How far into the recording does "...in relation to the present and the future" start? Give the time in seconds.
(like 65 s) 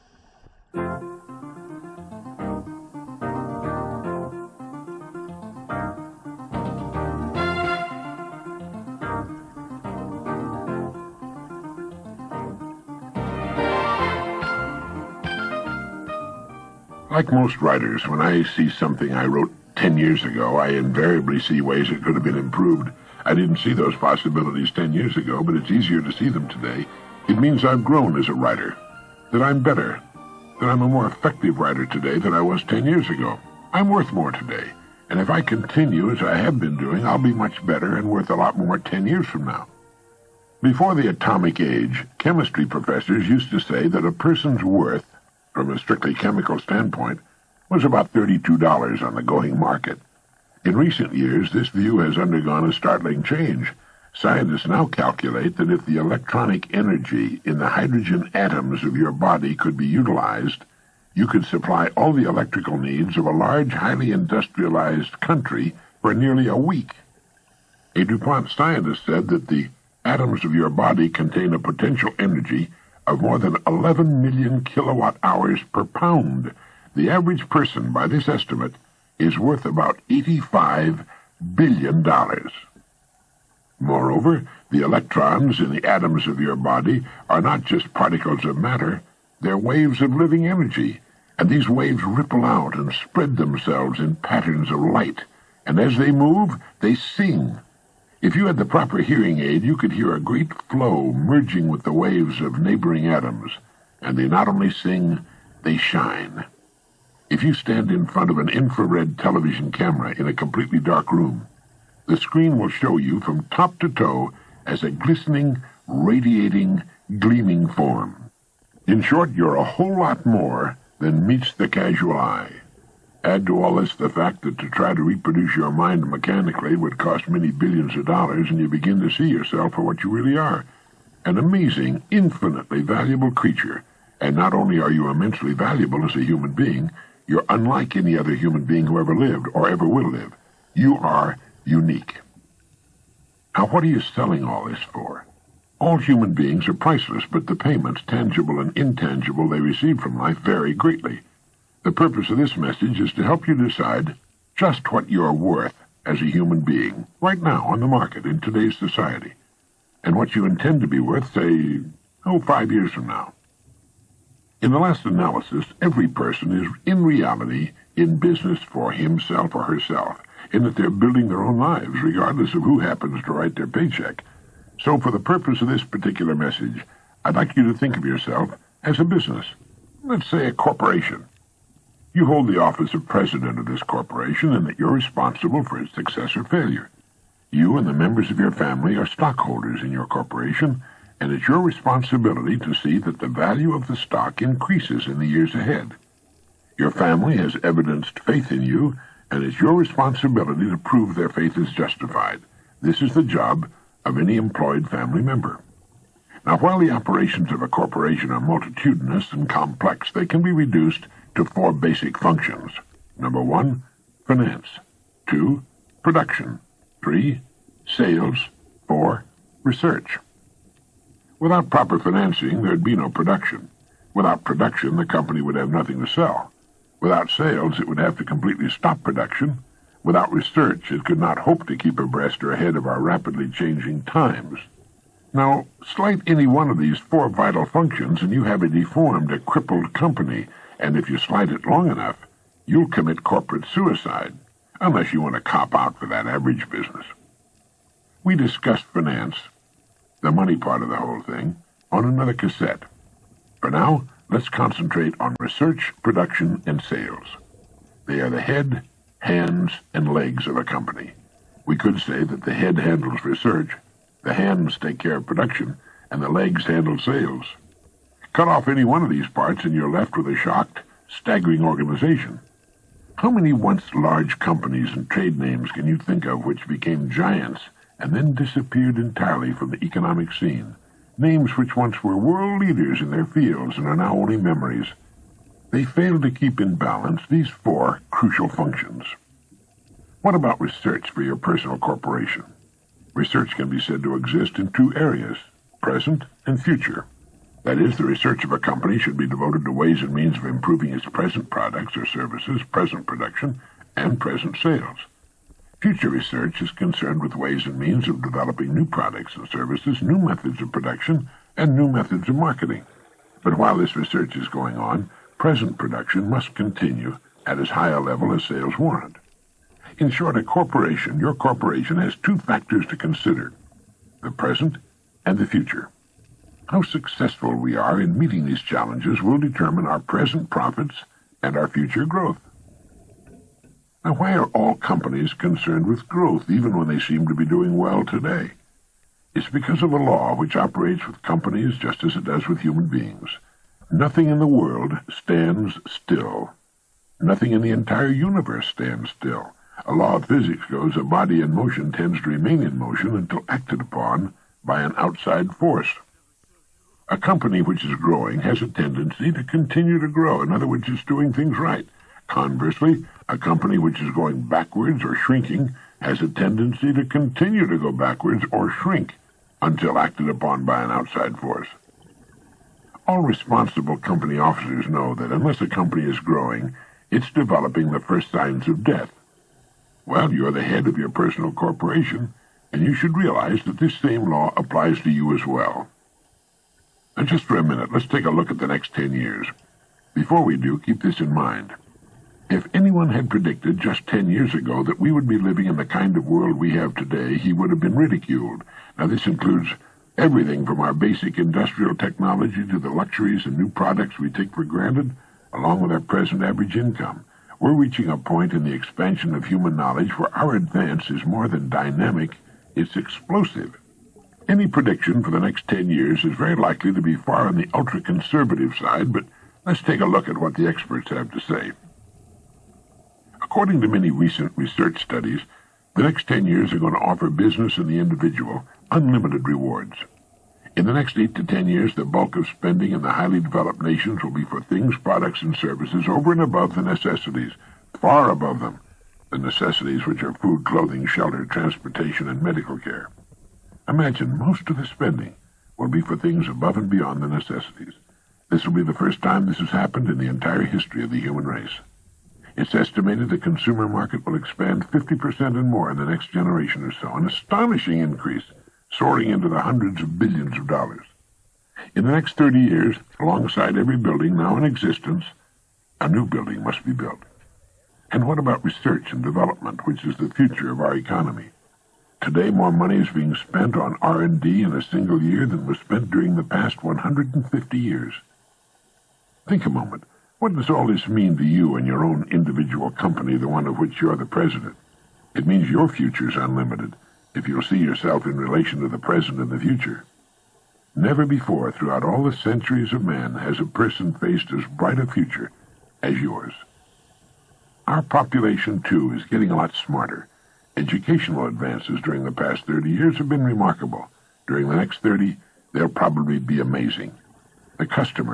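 488 s.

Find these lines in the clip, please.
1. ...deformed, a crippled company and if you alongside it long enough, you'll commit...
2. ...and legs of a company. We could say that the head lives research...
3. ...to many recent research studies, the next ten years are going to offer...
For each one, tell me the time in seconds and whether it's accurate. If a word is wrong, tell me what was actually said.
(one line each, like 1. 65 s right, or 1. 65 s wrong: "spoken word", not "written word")
1. 238 s wrong: "slide", not "alongside"
2. 259 s wrong: "handles", not "lives"
3. 423 s right.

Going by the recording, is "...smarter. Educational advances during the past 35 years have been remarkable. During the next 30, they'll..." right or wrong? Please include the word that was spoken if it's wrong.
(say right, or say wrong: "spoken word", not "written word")
wrong: "30", not "35".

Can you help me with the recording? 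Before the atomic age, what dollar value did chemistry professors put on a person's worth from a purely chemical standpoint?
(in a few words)
$32.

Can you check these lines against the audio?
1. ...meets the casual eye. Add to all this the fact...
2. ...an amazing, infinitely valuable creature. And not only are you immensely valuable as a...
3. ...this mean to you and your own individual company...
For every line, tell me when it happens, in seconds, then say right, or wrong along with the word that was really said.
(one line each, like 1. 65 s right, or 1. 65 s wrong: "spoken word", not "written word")
1. 121 s right
2. 131 s right
3. 480 s right.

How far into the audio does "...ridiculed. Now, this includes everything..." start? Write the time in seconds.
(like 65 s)
397 s.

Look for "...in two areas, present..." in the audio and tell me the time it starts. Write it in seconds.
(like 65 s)
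294 s.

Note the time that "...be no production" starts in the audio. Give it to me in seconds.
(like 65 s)
222 s.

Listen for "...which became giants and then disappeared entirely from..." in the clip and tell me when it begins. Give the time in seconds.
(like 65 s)
276 s.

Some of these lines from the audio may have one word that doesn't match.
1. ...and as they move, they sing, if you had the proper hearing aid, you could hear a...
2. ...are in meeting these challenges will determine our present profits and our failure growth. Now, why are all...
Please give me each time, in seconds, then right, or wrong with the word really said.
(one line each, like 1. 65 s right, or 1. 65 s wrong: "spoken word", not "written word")
1. 95 s right
2. 327 s wrong: "future", not "failure".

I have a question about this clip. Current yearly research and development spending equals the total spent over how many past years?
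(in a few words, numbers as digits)
150 years.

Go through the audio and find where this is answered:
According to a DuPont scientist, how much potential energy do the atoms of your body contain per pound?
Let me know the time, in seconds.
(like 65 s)
73 s.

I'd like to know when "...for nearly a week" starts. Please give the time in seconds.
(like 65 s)
66 s.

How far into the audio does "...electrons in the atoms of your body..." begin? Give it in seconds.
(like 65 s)
84 s.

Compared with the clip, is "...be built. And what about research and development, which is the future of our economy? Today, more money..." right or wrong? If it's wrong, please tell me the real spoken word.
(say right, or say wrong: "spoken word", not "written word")
right.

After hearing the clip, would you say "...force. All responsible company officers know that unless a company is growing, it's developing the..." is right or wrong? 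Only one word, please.
right.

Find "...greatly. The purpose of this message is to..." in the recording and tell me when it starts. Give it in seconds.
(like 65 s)
150 s.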